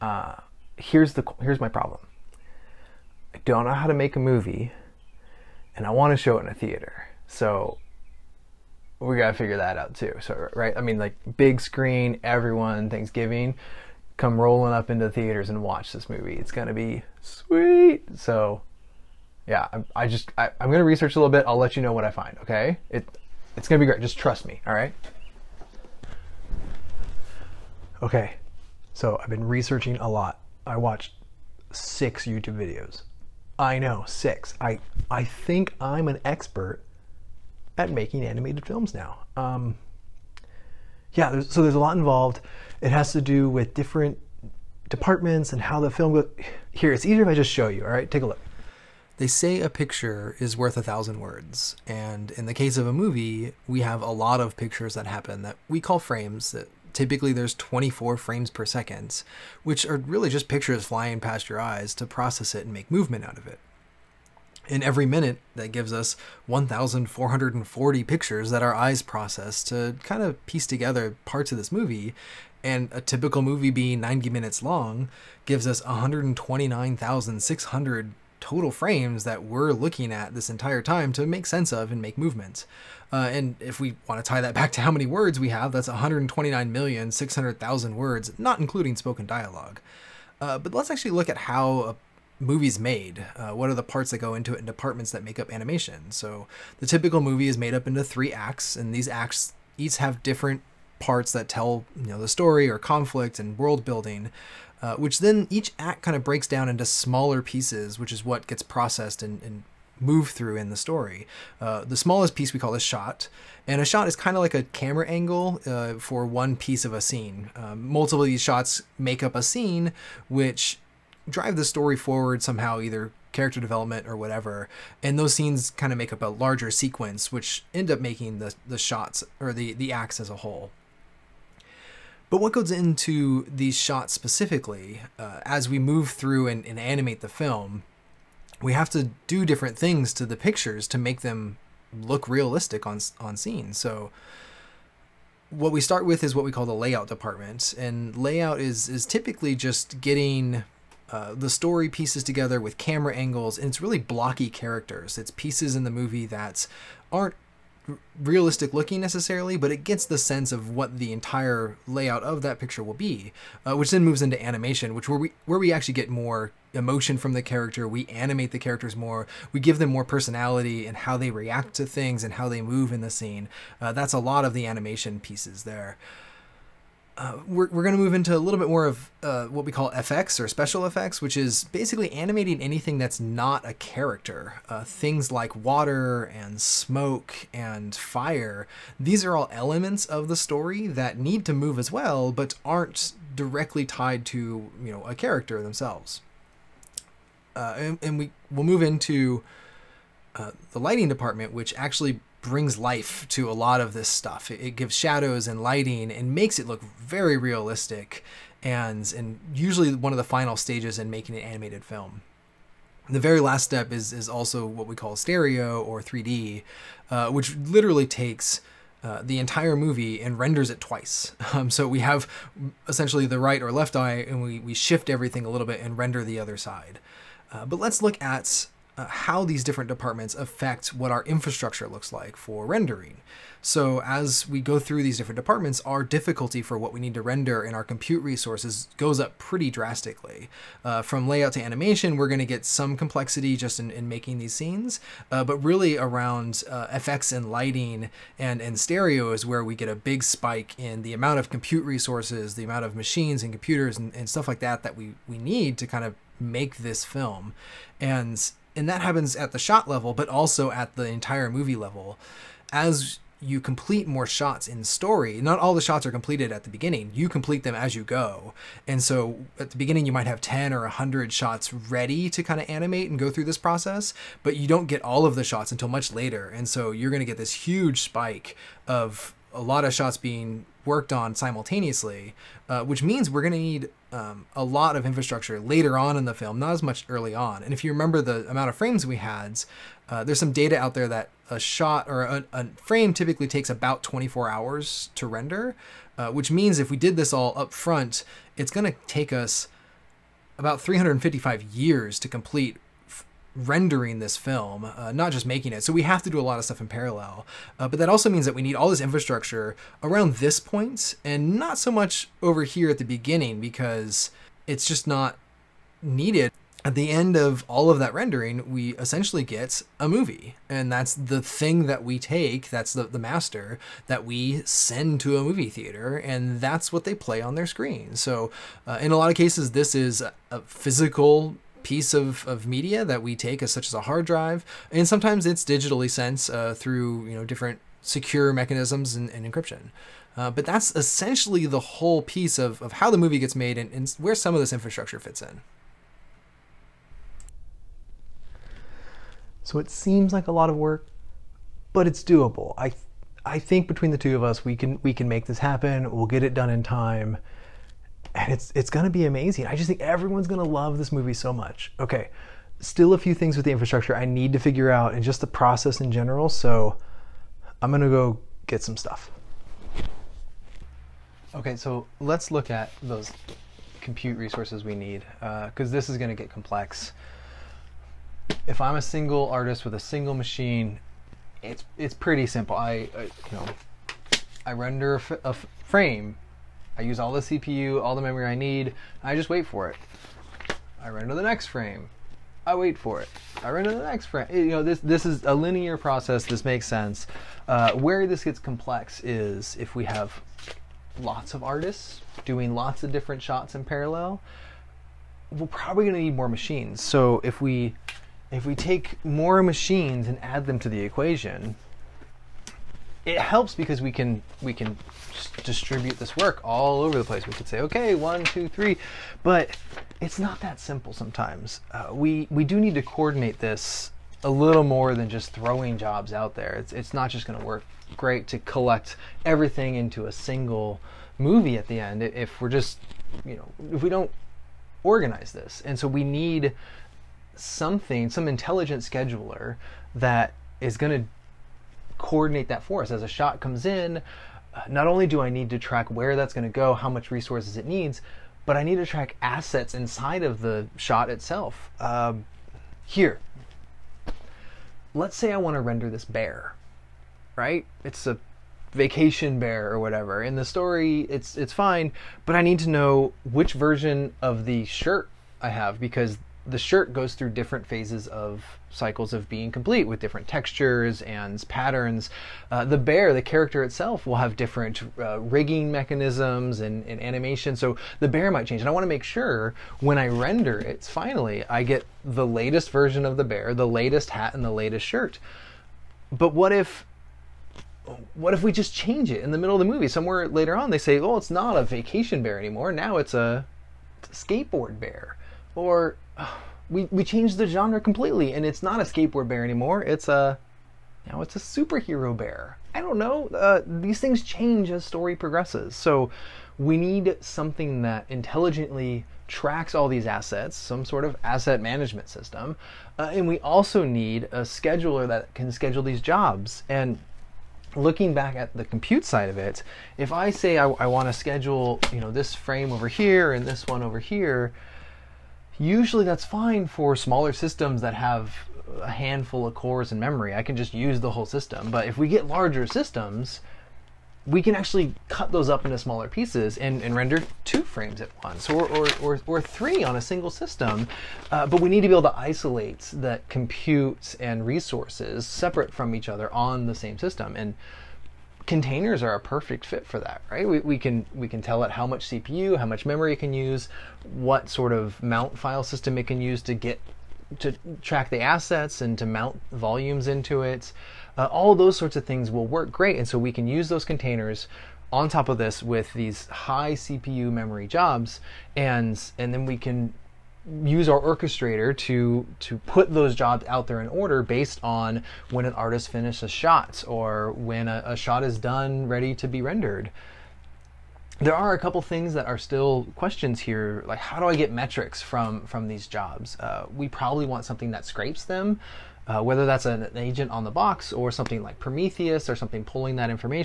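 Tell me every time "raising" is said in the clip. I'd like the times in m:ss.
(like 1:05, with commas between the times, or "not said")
not said.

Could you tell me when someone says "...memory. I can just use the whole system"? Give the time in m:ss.
8:50.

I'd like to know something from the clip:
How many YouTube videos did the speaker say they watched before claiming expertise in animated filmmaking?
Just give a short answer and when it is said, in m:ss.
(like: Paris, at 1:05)
6, at 0:31.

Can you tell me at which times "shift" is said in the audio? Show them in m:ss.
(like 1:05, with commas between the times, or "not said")
3:44.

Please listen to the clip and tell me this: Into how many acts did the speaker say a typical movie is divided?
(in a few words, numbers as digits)
3.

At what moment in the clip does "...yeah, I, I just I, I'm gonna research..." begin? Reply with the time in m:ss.
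0:19.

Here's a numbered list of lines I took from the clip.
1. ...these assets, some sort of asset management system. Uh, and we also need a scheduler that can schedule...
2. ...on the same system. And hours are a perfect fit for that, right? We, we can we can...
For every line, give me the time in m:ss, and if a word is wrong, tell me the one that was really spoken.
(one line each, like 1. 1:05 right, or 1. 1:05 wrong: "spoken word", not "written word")
1. 8:30 right
2. 9:06 wrong: "containers", not "hours".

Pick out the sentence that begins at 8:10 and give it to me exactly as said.
Somewhere later on, they say, "Oh, it's not a vacation bear anymore.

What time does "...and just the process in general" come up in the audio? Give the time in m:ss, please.
6:05.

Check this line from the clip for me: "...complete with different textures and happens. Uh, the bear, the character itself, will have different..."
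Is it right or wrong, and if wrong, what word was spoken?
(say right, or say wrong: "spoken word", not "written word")
wrong: "patterns", not "happens".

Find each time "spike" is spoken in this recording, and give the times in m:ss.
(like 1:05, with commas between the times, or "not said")
4:10, 4:37.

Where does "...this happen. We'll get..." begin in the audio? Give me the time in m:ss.
5:55.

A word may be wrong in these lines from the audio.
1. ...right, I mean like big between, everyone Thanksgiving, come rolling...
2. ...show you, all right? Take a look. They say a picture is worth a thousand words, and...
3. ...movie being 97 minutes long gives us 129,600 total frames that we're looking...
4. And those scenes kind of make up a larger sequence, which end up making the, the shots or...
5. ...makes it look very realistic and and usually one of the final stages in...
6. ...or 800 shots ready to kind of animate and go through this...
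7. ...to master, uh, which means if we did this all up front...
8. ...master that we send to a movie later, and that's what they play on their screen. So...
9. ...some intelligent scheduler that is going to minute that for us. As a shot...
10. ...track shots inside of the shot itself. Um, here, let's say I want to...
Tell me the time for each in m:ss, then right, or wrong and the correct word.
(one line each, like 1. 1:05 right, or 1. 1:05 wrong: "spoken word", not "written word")
1. 0:10 wrong: "screen", not "between"
2. 0:47 right
3. 1:13 wrong: "90", not "97"
4. 2:05 right
5. 3:26 right
6. 4:30 wrong: "100", not "800"
7. 4:55 wrong: "render", not "master"
8. 5:23 wrong: "theater", not "later"
9. 7:18 wrong: "coordinate", not "minute"
10. 7:29 wrong: "assets", not "shots".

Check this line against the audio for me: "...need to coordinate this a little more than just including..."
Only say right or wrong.
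wrong.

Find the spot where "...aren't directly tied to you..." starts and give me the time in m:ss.
3:12.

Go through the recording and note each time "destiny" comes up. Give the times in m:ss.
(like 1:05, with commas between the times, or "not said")
not said.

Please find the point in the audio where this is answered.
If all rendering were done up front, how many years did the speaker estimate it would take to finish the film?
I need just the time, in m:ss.
5:00.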